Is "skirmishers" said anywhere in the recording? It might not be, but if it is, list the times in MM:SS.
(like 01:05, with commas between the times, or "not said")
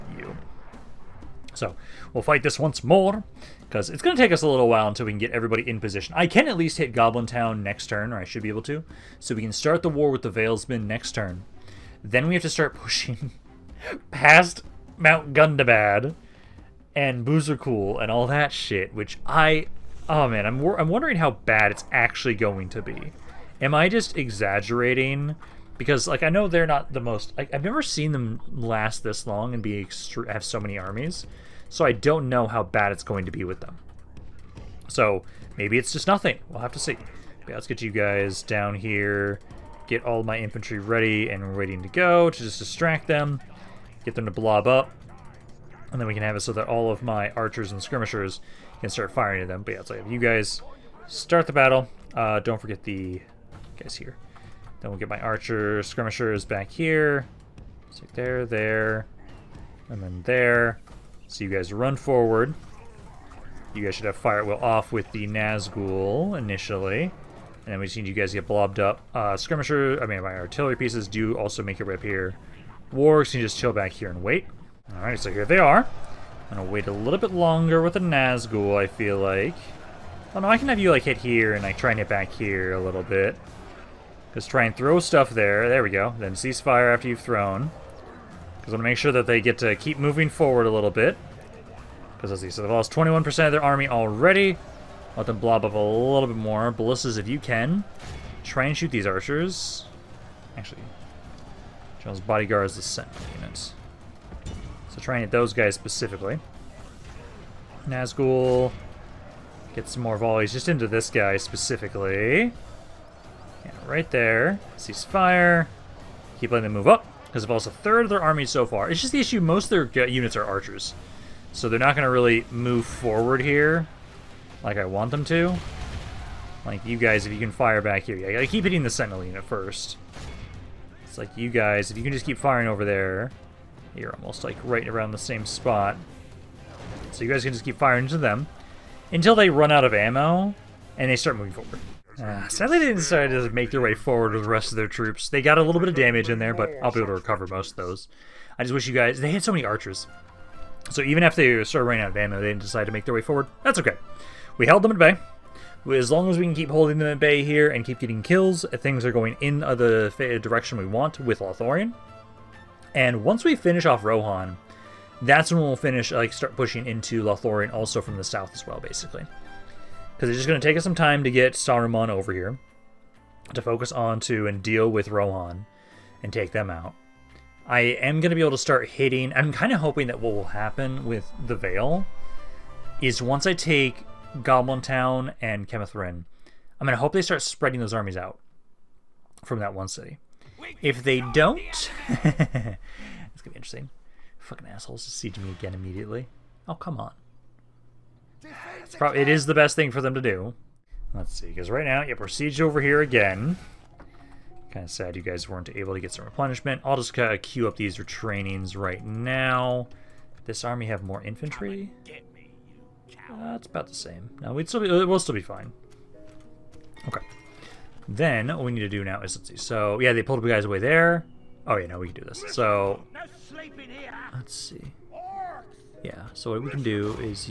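00:47, 00:55, 01:09.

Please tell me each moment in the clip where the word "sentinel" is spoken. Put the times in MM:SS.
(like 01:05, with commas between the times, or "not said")
01:42, 02:08.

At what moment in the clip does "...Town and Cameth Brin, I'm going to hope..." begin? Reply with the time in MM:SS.
03:04.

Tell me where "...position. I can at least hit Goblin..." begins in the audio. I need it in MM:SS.
00:05.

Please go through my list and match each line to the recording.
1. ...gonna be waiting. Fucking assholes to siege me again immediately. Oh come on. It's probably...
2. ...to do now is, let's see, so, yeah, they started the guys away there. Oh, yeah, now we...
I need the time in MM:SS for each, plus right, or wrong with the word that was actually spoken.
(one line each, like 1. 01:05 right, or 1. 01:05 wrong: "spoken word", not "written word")
1. 03:12 wrong: "interesting", not "waiting"
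2. 03:38 wrong: "pulled", not "started".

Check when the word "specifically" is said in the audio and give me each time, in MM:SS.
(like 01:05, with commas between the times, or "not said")
01:45, 01:51.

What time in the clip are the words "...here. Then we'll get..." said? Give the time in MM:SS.
00:53.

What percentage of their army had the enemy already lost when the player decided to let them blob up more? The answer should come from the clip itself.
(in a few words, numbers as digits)
21%.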